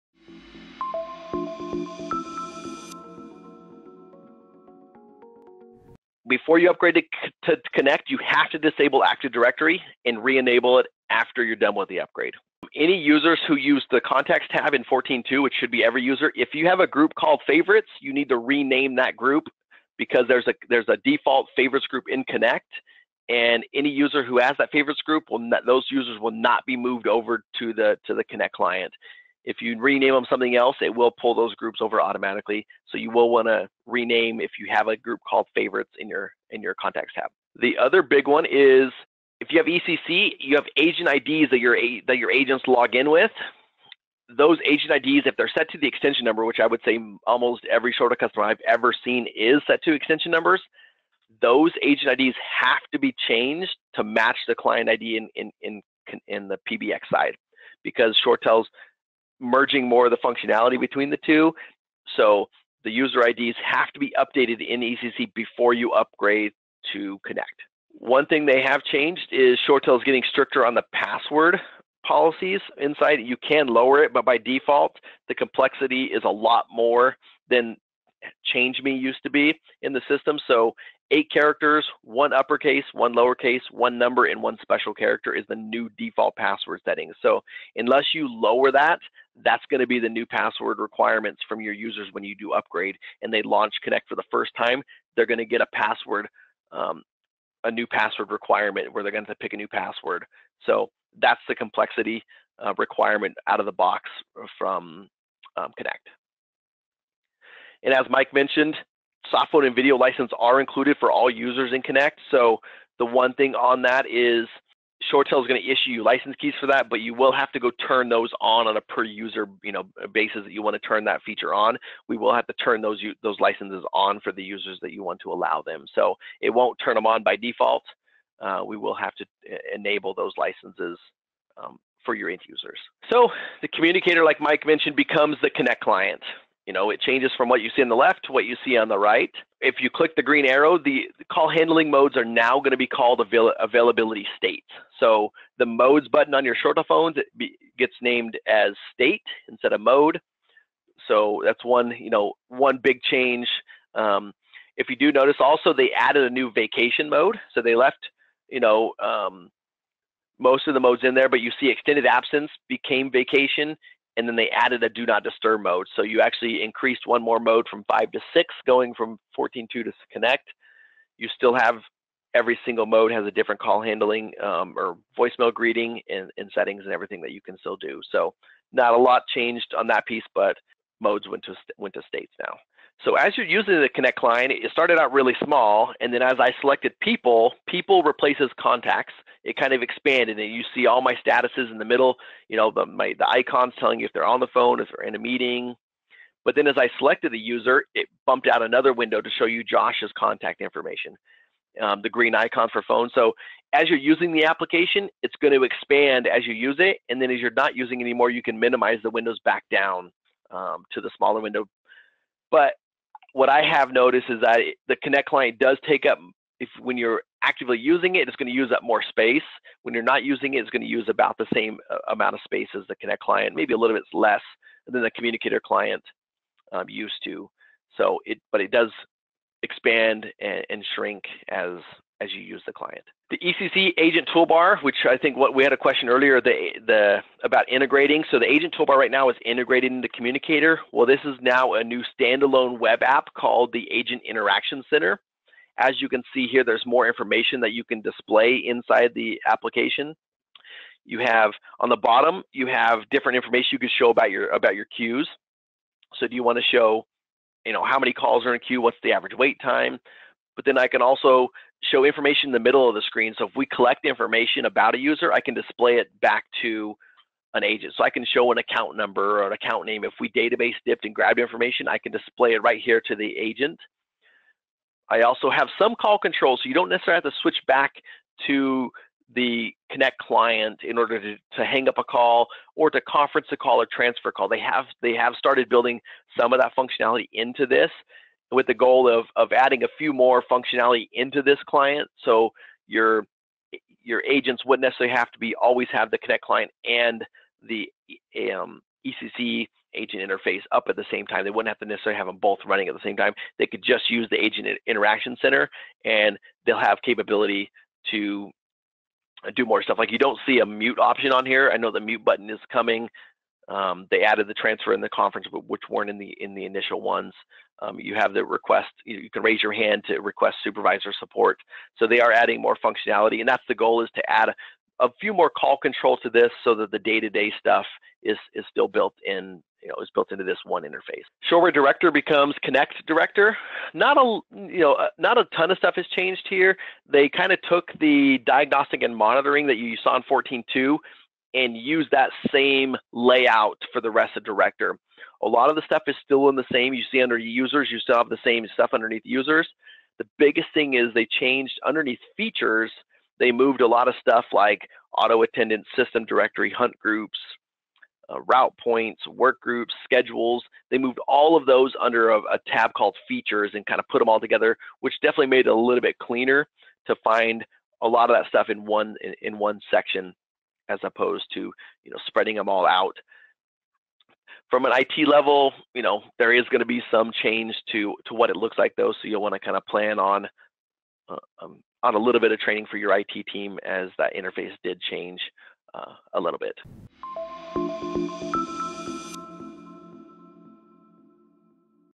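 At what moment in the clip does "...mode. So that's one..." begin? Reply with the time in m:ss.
2:29.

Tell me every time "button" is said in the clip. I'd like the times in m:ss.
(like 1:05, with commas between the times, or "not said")
2:26, 5:12.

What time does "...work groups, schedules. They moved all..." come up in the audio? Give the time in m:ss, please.
5:59.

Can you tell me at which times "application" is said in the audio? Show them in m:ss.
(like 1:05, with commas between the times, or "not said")
3:24, 4:09.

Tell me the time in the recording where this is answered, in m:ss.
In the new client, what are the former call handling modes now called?
2:23.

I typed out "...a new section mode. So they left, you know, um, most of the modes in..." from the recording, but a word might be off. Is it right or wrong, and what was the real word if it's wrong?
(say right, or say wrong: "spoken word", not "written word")
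wrong: "vacation", not "section".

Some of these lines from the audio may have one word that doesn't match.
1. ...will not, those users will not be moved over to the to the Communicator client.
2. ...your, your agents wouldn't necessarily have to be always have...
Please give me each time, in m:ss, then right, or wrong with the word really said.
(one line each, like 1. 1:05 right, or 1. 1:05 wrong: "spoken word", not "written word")
1. 0:25 wrong: "Connect", not "Communicator"
2. 4:52 right.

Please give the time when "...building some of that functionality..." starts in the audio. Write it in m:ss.
4:45.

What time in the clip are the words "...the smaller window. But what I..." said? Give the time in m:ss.
3:31.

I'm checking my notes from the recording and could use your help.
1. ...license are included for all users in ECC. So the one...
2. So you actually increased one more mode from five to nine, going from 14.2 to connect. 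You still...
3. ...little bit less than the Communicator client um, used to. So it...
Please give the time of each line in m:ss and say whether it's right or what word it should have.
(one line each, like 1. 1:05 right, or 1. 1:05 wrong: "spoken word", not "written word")
1. 1:49 wrong: "Connect", not "ECC"
2. 2:45 wrong: "six", not "nine"
3. 3:43 right.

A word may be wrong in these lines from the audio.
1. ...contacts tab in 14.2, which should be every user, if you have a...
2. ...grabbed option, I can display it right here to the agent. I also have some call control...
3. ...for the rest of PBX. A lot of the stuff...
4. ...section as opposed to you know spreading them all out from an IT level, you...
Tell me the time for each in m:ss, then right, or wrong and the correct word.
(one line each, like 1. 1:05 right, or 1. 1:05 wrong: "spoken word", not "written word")
1. 0:13 right
2. 4:31 wrong: "information", not "option"
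3. 5:43 wrong: "Director", not "PBX"
4. 6:09 right.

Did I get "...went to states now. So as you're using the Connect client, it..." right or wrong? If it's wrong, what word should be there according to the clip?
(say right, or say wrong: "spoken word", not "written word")
right.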